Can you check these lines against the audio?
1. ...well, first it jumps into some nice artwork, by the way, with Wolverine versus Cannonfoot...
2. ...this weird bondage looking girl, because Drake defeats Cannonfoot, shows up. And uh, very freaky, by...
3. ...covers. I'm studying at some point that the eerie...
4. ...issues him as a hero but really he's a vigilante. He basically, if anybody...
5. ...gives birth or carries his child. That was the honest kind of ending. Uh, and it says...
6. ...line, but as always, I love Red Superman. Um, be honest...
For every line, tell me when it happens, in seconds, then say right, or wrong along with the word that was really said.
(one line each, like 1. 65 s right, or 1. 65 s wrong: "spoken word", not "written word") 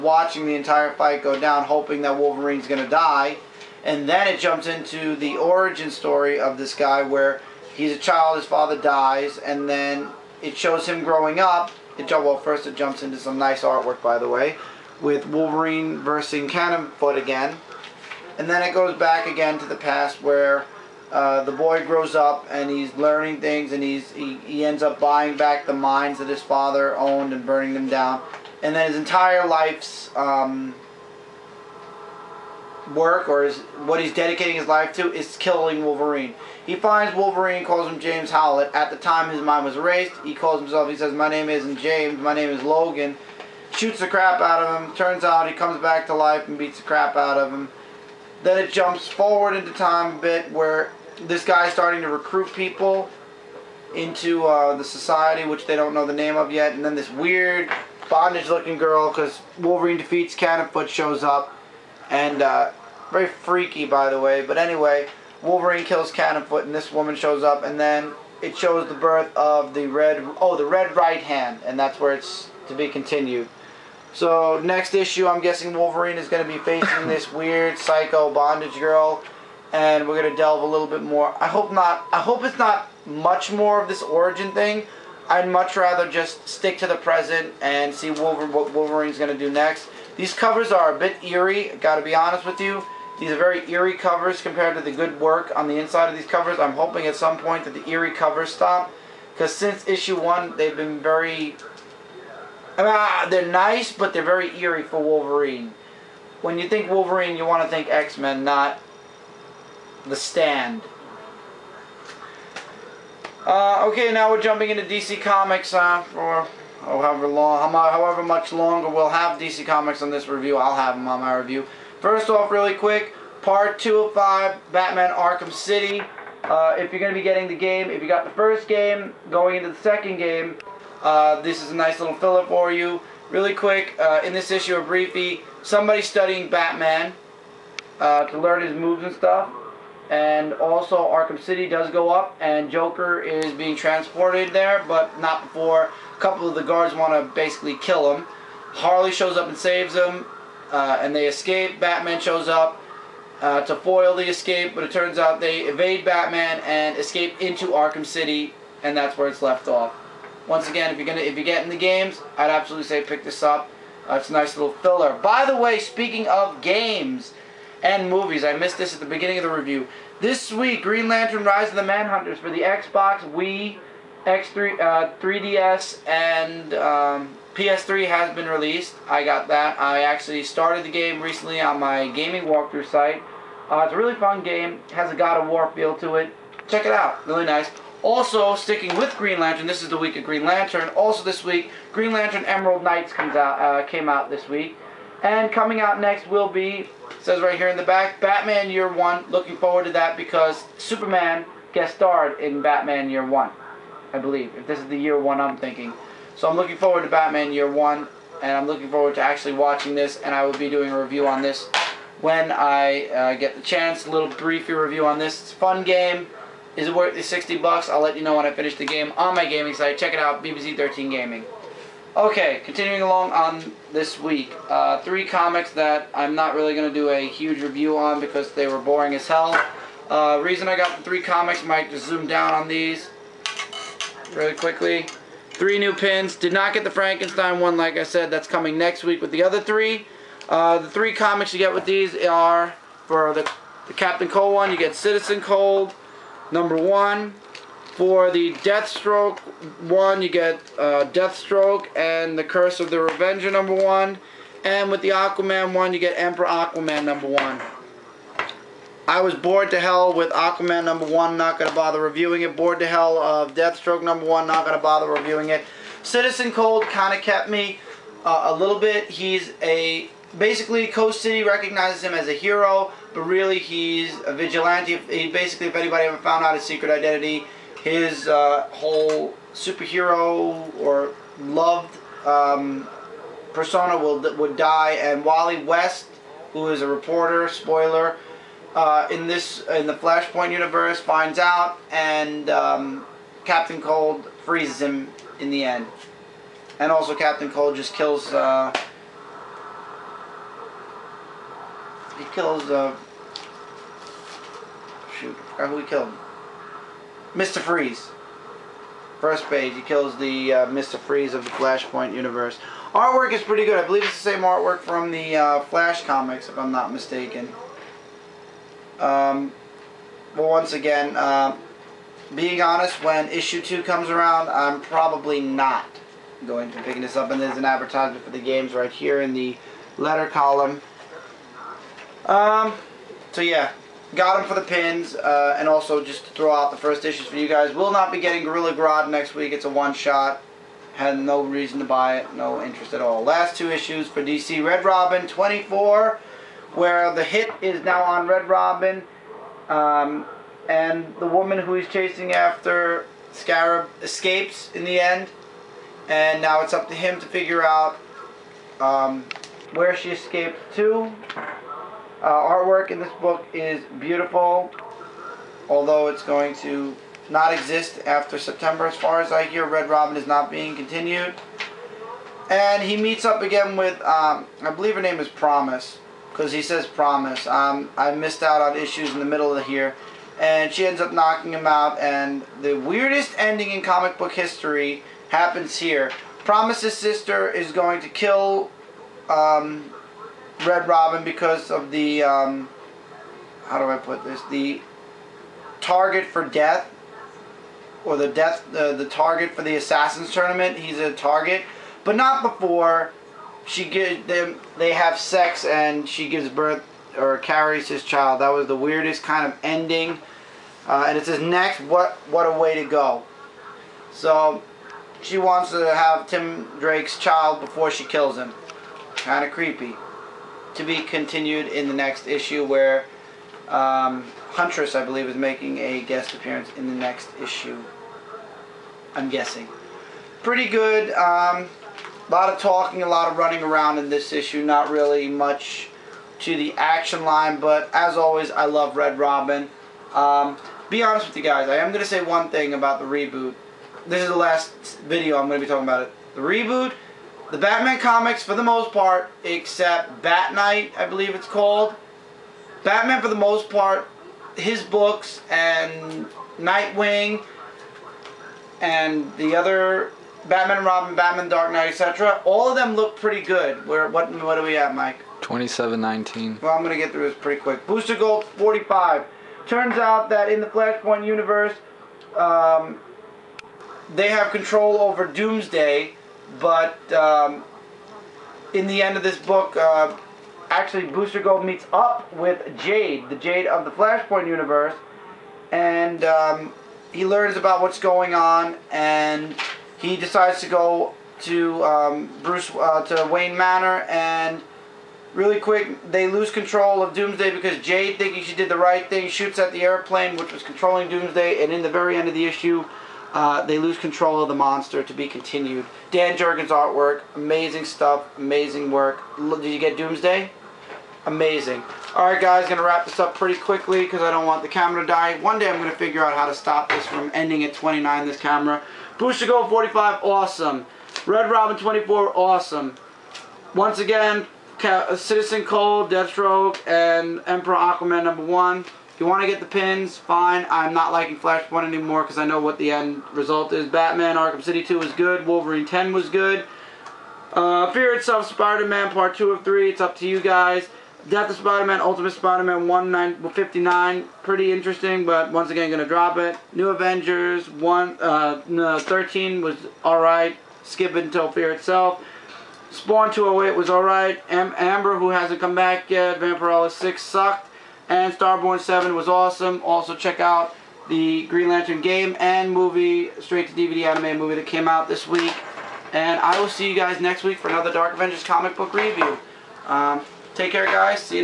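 1. 12 s right
2. 56 s wrong: "Wolverine", not "Drake"
3. 96 s wrong: "hoping", not "studying"
4. 271 s wrong: "recognizes", not "issues"
5. 406 s wrong: "weirdest", not "honest"
6. 437 s wrong: "Robin", not "Superman".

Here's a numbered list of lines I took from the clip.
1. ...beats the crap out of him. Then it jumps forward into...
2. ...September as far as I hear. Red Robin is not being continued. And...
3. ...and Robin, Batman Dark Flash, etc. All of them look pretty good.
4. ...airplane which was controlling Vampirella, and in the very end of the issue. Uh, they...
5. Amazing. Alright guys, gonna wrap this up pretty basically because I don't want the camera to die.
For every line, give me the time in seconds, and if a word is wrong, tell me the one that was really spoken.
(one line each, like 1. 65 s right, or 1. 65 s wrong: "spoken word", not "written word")
1. 46 s right
2. 368 s right
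3. 460 s wrong: "Knight", not "Flash"
4. 499 s wrong: "Doomsday", not "Vampirella"
5. 511 s wrong: "quickly", not "basically".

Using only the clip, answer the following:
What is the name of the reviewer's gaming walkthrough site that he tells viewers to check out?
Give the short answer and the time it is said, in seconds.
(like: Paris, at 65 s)
BBC13 Gaming, at 220 s.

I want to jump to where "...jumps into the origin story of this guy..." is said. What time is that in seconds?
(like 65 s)
4 s.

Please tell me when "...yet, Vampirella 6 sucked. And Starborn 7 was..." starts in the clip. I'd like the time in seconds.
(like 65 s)
556 s.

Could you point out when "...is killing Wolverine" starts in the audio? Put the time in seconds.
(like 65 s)
35 s.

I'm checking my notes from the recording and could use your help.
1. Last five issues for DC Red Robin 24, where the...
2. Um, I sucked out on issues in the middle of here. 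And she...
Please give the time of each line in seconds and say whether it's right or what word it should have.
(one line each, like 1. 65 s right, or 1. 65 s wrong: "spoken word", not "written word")
1. 343 s wrong: "two", not "five"
2. 377 s wrong: "missed", not "sucked".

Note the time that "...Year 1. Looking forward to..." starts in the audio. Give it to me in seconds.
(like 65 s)
198 s.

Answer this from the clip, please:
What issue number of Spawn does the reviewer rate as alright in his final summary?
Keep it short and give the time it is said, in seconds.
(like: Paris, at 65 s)
208, at 552 s.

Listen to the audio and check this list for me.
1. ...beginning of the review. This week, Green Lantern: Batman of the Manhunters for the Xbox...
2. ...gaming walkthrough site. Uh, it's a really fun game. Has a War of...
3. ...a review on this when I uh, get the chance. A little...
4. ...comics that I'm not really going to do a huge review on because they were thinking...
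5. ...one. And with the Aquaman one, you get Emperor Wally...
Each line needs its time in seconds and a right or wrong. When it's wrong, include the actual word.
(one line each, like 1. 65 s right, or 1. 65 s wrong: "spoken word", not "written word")
1. 169 s wrong: "Rise", not "Batman"
2. 182 s wrong: "God", not "War"
3. 210 s right
4. 225 s wrong: "boring", not "thinking"
5. 253 s wrong: "Aquaman", not "Wally".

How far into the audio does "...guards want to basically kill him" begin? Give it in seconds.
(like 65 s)
146 s.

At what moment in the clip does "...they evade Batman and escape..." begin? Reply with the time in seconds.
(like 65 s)
155 s.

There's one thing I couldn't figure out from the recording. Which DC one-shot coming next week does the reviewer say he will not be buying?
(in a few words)
Gorilla Grodd.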